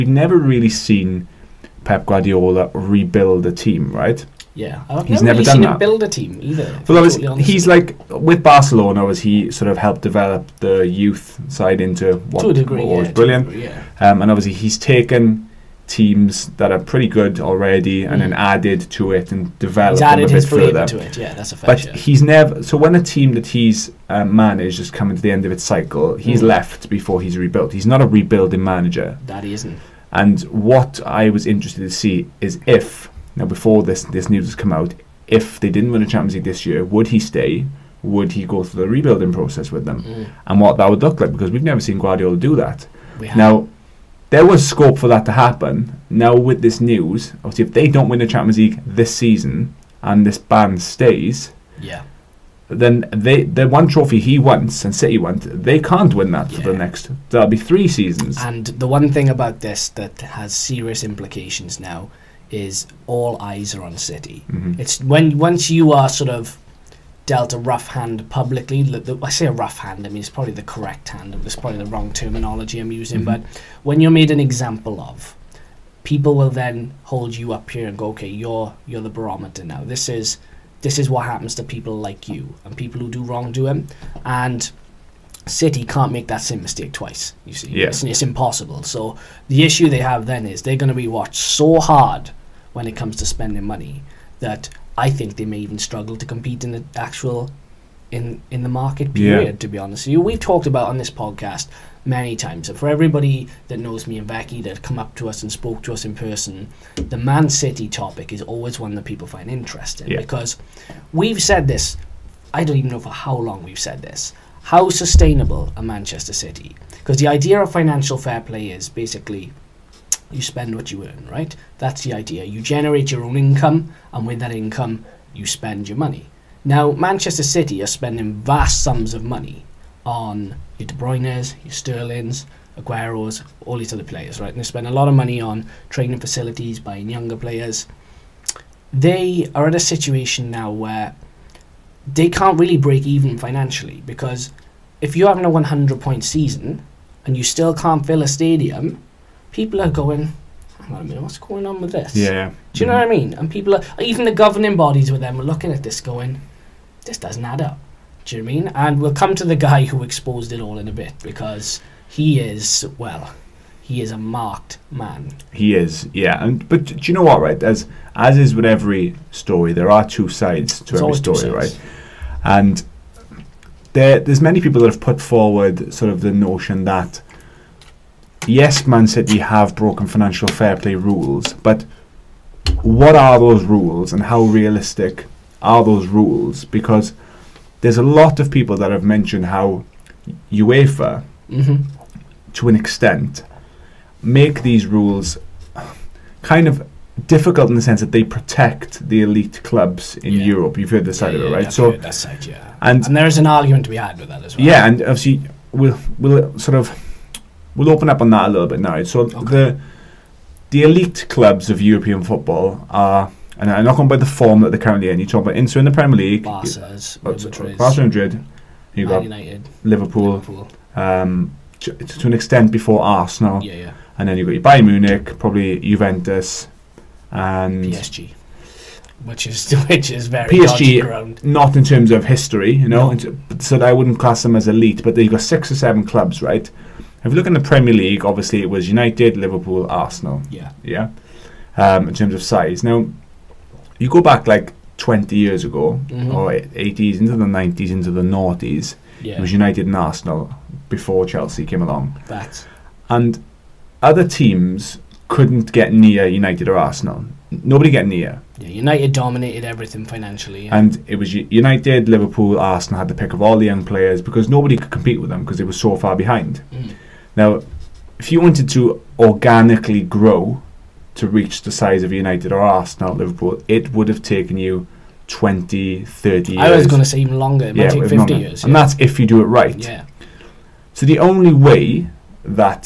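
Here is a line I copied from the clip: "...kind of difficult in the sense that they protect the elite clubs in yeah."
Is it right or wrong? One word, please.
right.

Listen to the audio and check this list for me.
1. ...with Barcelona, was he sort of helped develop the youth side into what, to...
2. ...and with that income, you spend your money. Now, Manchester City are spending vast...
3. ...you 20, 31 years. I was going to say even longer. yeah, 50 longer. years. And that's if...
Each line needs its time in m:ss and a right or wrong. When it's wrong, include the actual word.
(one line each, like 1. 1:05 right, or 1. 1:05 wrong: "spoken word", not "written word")
1. 0:08 right
2. 2:04 right
3. 4:34 wrong: "30", not "31".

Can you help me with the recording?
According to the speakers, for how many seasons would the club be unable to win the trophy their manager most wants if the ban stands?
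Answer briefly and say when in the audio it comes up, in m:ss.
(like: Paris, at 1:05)
3, at 0:57.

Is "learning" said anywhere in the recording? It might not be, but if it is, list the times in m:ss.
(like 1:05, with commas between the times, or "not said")
not said.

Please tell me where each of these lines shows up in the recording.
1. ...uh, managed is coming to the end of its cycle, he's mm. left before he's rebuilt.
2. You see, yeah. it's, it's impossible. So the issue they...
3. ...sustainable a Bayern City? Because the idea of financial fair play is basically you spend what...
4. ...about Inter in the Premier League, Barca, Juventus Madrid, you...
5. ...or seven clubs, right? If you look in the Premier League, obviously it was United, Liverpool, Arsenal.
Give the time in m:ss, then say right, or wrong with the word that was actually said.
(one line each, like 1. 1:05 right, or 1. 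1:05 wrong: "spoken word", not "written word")
1. 0:24 right
2. 1:27 right
3. 1:54 wrong: "Manchester", not "Bayern"
4. 3:35 wrong: "Barca", not "Juventus"
5. 3:55 right.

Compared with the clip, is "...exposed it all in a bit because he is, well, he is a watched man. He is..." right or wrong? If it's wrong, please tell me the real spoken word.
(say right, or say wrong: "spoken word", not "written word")
wrong: "marked", not "watched".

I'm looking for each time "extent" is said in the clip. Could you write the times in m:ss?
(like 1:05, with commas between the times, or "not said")
3:12, 3:42.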